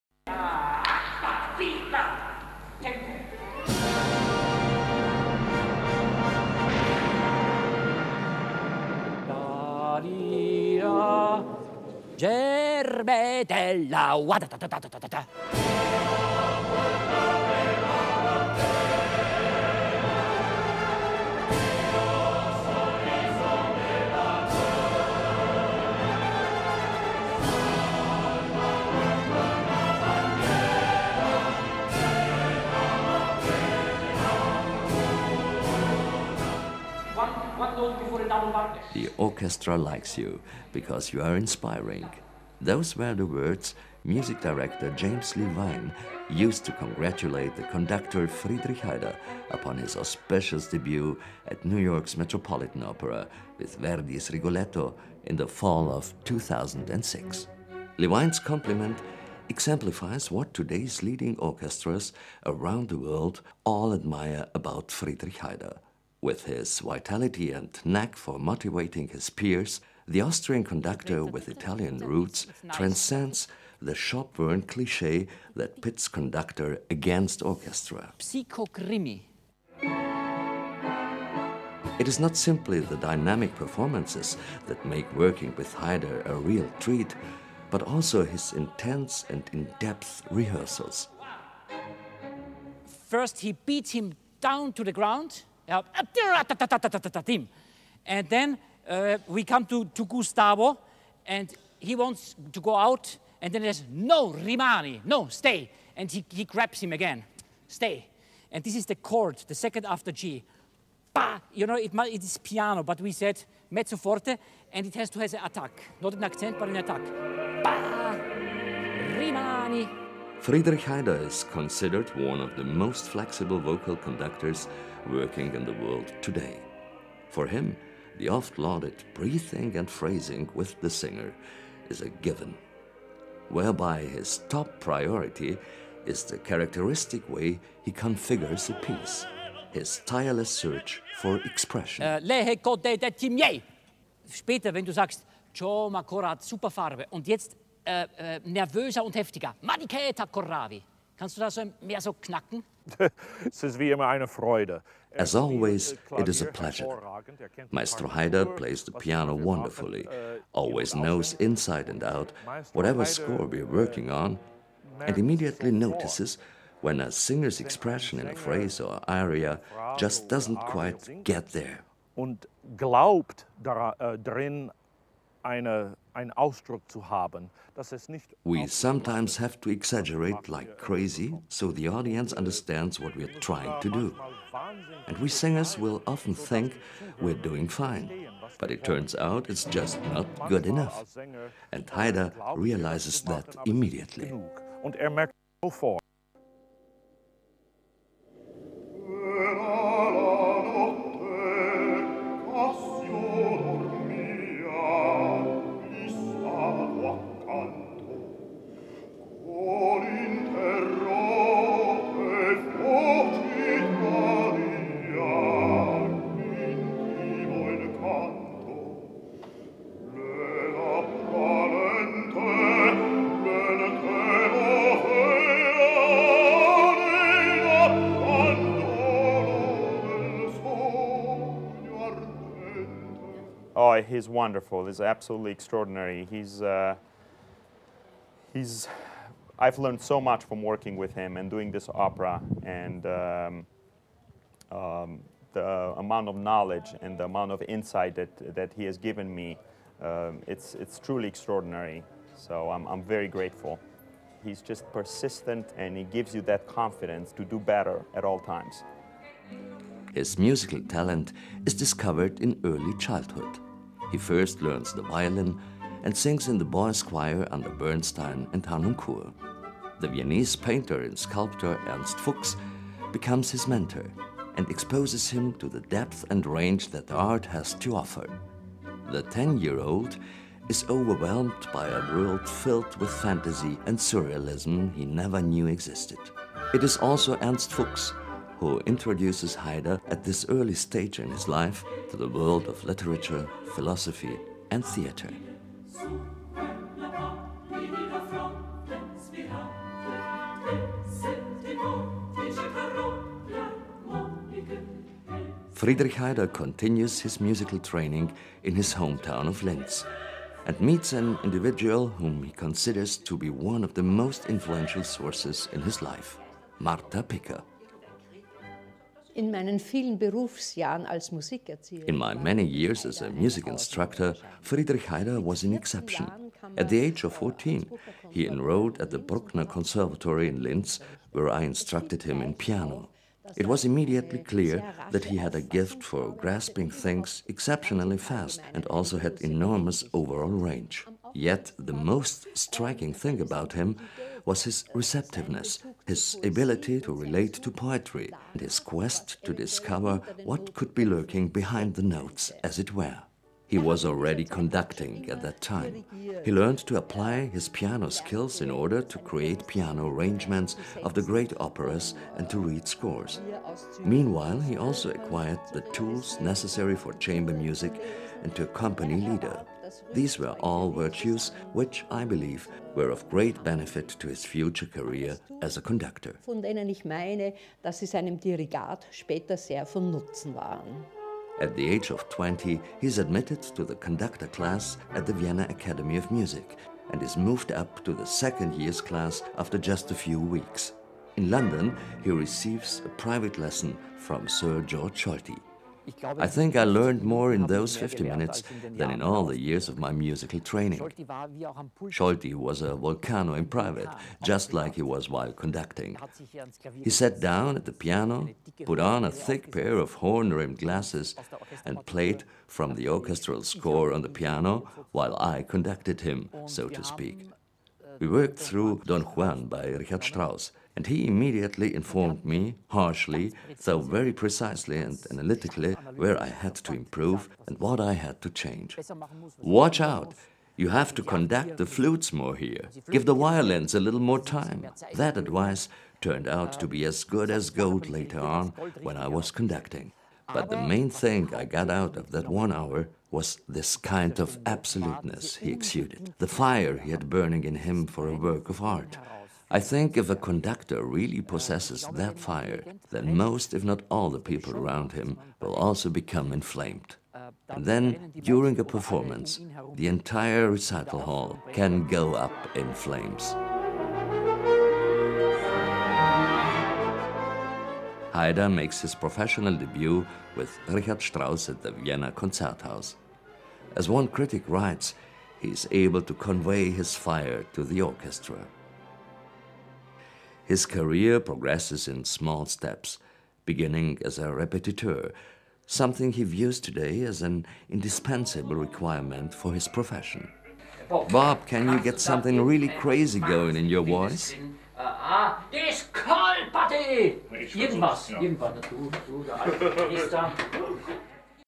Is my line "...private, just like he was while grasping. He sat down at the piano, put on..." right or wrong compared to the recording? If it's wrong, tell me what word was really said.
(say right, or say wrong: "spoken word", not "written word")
wrong: "conducting", not "grasping".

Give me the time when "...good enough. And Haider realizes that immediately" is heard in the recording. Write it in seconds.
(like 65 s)
190 s.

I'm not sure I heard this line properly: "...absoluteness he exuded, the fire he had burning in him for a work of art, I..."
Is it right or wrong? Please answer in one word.
right.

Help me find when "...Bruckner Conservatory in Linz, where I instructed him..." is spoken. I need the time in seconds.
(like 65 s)
329 s.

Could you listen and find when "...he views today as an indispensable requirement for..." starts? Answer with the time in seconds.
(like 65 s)
486 s.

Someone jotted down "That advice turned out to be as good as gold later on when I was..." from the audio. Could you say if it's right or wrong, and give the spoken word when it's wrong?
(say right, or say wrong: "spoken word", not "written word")
right.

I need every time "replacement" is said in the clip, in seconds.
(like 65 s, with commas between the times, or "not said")
not said.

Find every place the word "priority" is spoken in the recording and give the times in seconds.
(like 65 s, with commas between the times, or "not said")
134 s.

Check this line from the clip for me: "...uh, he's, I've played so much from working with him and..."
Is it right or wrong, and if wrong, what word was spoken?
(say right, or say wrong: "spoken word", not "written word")
wrong: "learned", not "played".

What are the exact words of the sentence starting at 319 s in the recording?
In my many years as a music instructor, Friedrich Haider was an exception.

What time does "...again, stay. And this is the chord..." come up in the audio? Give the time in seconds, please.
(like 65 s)
106 s.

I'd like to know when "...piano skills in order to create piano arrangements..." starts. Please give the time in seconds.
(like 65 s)
357 s.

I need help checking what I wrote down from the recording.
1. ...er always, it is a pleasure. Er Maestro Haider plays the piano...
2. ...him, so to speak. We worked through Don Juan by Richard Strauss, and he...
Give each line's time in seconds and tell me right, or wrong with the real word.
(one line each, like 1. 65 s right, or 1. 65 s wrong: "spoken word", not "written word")
1. 155 s right
2. 416 s right.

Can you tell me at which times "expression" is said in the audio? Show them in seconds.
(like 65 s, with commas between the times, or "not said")
141 s, 167 s.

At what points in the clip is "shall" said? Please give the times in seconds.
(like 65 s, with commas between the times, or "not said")
not said.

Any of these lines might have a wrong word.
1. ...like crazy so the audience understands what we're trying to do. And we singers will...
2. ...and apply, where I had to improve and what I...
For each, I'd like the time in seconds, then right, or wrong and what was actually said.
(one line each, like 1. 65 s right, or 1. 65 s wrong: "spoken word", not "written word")
1. 180 s right
2. 424 s wrong: "analytically", not "apply".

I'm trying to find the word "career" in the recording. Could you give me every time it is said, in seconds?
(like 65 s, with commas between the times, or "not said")
374 s, 480 s.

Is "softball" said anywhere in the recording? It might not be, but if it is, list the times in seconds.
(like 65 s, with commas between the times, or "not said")
not said.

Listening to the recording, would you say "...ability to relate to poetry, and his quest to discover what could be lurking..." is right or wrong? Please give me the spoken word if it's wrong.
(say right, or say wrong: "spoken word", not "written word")
right.